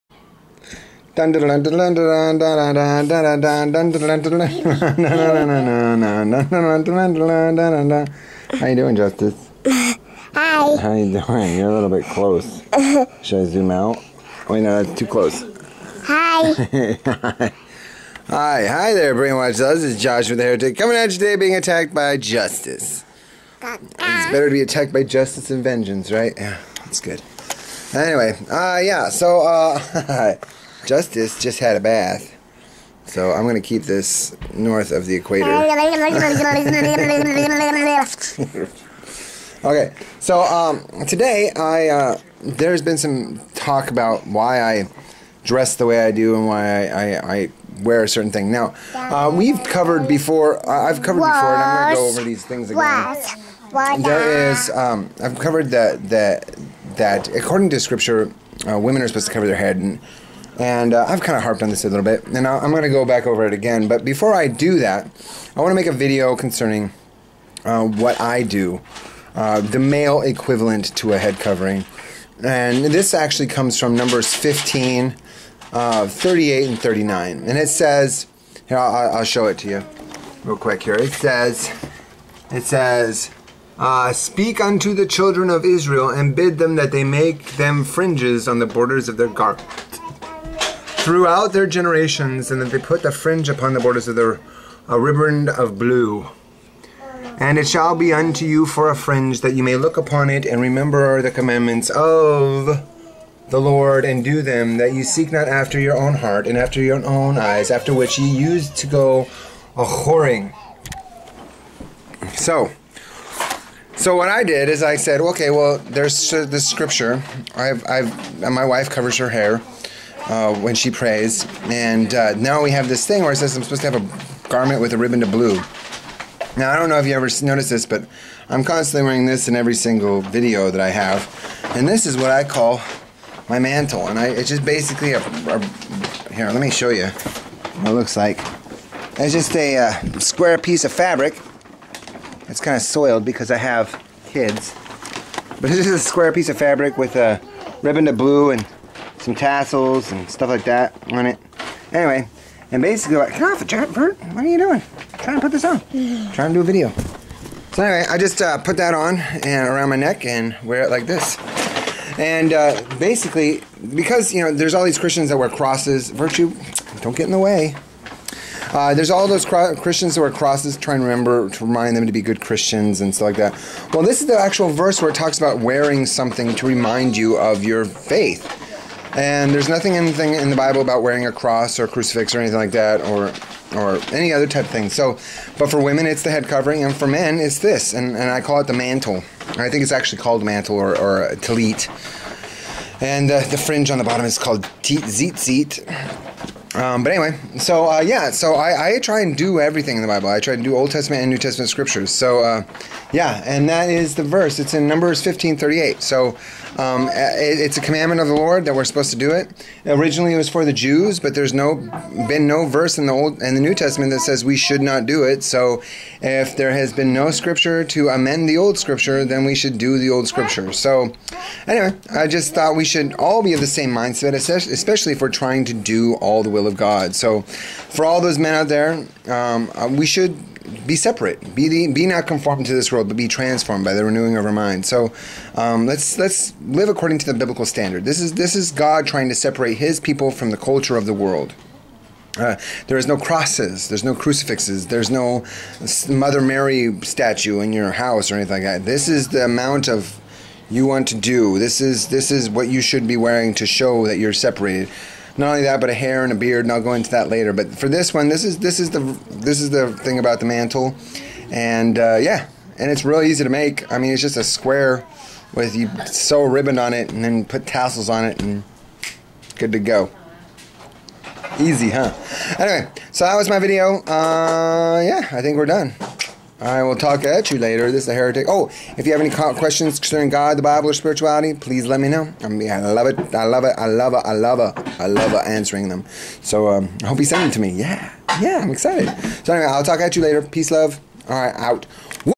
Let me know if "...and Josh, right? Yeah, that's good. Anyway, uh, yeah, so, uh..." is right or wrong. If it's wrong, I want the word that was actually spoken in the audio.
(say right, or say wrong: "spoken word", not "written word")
wrong: "Vengeance", not "Josh".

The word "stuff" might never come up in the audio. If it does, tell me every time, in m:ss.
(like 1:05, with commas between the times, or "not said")
2:30, 2:53.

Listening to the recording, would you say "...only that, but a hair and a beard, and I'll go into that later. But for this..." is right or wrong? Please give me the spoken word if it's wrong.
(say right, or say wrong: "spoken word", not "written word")
right.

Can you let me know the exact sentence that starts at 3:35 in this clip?
So if there has been no scripture to amend the old scripture, then we should do the old scripture.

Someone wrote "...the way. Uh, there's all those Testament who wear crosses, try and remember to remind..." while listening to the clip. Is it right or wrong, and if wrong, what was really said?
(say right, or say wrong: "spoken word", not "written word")
wrong: "Christians", not "Testament".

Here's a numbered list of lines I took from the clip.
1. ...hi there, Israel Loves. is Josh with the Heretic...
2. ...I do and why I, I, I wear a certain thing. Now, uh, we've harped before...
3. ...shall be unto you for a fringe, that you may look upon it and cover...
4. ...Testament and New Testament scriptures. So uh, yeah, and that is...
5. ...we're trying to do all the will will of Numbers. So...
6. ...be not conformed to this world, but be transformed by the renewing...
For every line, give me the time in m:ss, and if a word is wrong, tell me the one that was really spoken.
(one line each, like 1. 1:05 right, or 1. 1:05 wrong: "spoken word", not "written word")
1. 0:18 wrong: "Brainwatch", not "Israel"
2. 0:46 wrong: "covered", not "harped"
3. 1:37 wrong: "remember", not "cover"
4. 3:20 right
5. 3:45 wrong: "God", not "Numbers"
6. 3:51 right.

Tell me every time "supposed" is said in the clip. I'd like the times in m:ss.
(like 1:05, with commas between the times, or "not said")
0:59, 2:03, 3:28.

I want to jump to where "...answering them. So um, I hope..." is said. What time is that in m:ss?
4:45.